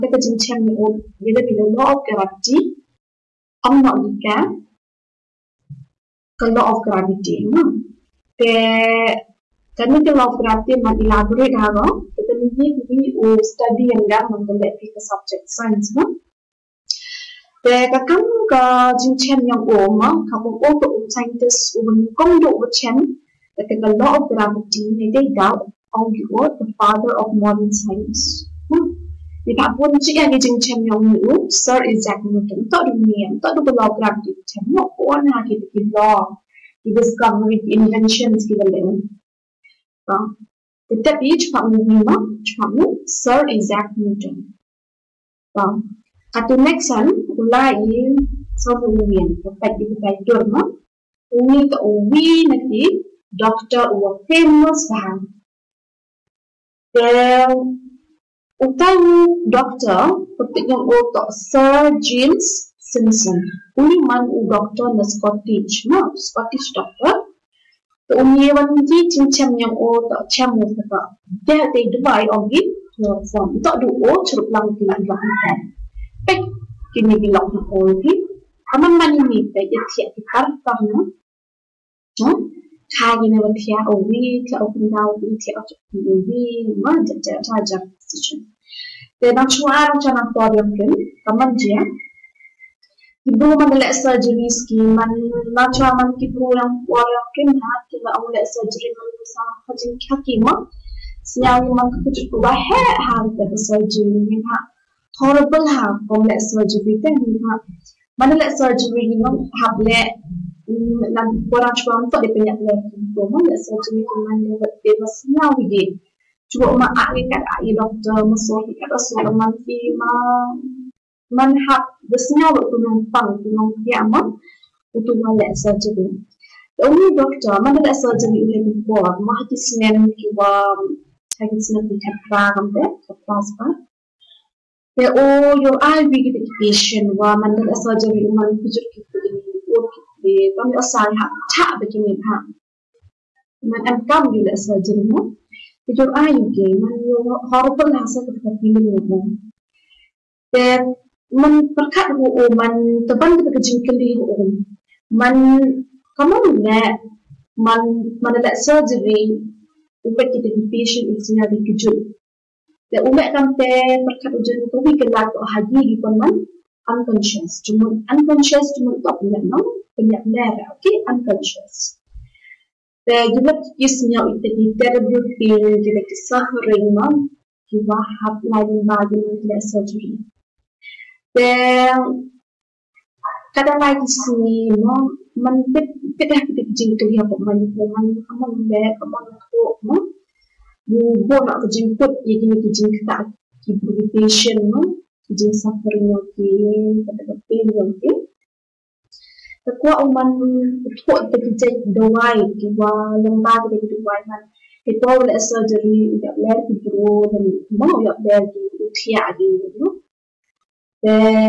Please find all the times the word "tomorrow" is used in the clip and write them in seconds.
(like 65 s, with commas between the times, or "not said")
not said.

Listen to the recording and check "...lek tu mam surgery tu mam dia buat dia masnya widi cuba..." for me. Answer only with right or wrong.
right.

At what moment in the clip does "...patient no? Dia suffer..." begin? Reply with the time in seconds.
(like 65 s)
194 s.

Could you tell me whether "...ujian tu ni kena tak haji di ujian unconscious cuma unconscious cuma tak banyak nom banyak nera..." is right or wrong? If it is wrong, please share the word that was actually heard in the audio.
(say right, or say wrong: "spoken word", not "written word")
wrong: "peman", not "ujian".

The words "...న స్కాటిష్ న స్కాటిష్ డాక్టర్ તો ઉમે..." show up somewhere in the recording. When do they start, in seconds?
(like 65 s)
64 s.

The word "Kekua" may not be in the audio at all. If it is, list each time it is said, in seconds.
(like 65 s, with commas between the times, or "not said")
199 s.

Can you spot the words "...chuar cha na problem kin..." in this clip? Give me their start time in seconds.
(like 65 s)
89 s.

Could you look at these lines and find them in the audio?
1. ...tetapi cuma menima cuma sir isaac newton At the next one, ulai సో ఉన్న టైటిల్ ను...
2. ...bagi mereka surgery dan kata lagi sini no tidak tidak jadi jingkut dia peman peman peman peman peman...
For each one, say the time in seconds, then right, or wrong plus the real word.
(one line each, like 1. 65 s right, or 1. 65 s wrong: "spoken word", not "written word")
1. 40 s right
2. 178 s right.